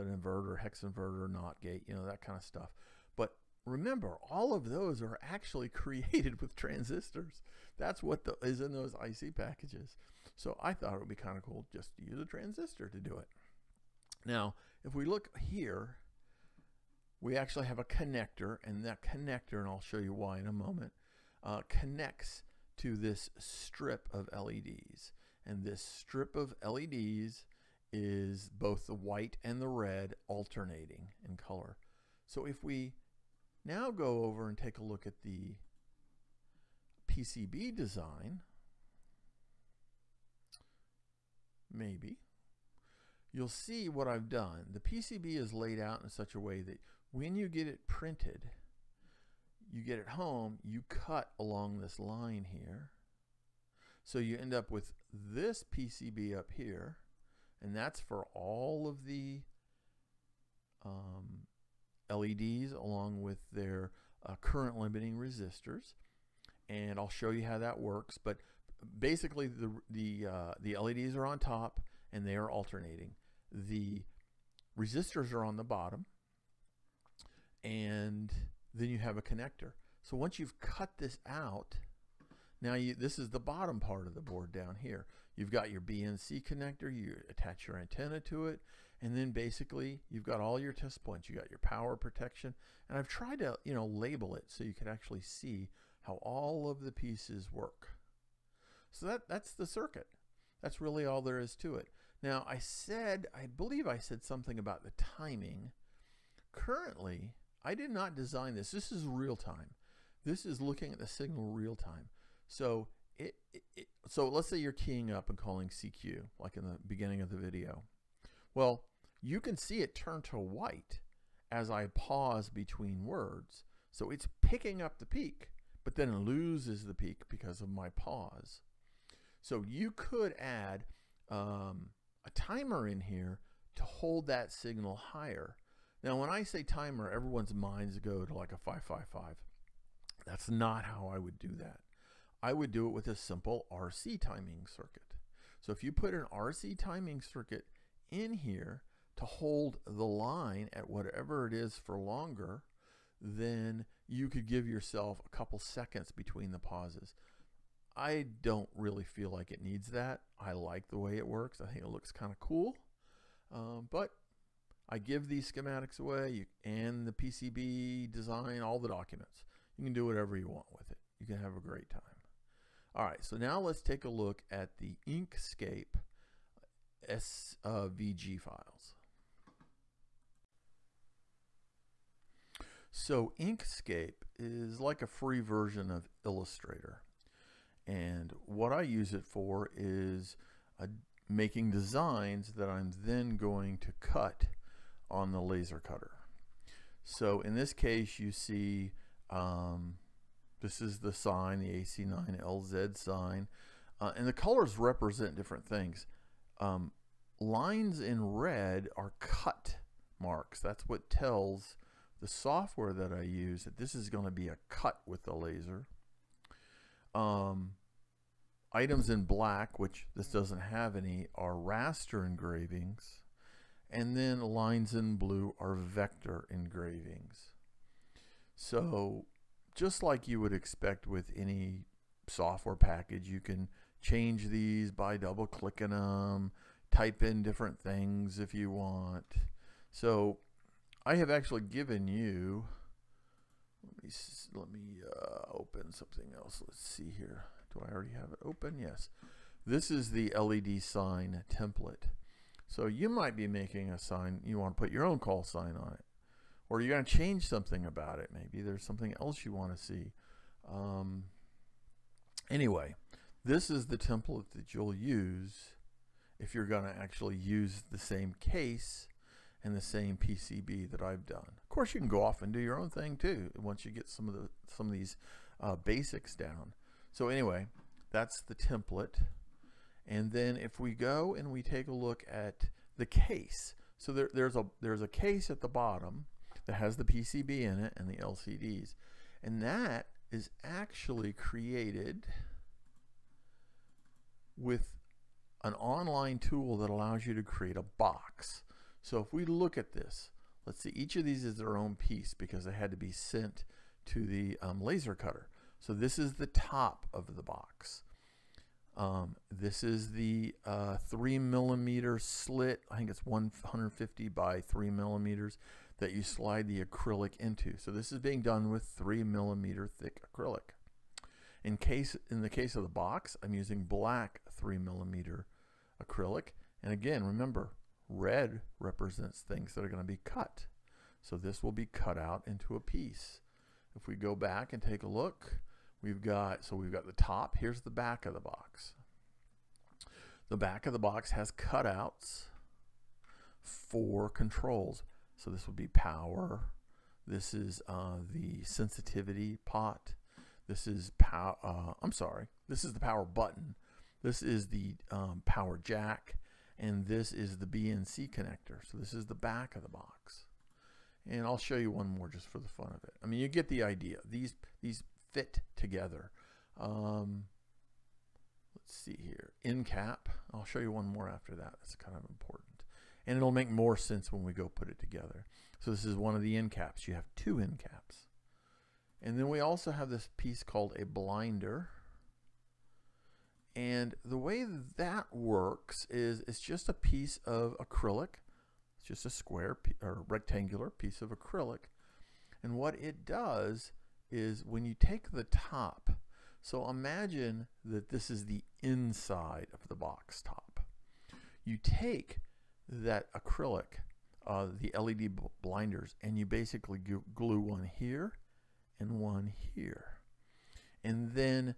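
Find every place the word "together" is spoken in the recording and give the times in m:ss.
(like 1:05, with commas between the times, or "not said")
6:05, 6:14.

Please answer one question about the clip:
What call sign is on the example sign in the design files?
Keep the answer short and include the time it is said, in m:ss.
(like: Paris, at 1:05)
AC9LZ, at 3:21.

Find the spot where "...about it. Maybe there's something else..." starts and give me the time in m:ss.
4:17.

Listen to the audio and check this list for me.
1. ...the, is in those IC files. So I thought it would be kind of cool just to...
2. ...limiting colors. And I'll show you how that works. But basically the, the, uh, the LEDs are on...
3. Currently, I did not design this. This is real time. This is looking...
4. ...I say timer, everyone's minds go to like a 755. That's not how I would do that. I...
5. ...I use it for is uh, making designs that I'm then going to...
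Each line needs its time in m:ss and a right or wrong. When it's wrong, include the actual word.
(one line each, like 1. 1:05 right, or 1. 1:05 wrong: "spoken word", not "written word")
1. 0:08 wrong: "packages", not "files"
2. 1:04 wrong: "resistors", not "colors"
3. 1:46 right
4. 2:16 wrong: "555", not "755"
5. 3:08 right.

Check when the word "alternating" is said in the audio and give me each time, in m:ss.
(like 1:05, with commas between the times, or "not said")
0:30, 1:12.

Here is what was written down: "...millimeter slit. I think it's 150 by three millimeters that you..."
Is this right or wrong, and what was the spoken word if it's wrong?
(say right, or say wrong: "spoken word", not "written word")
right.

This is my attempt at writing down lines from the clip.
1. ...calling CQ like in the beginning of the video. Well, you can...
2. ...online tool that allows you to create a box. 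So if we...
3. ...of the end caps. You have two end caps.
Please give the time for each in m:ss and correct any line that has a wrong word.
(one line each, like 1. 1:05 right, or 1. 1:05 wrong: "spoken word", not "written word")
1. 1:55 right
2. 4:55 right
3. 6:16 right.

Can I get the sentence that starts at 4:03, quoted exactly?
Let me let me uh, open something else.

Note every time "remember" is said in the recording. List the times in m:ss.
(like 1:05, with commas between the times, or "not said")
0:03, 5:27.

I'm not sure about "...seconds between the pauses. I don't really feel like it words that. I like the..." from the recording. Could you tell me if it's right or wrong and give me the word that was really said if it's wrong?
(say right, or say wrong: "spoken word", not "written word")
wrong: "needs", not "words".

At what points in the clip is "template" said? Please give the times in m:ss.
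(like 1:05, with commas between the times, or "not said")
4:11, 4:23, 4:38.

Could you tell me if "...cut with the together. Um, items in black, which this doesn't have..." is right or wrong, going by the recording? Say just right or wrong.
wrong.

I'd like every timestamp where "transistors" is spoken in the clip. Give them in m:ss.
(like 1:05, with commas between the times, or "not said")
0:06, 0:12.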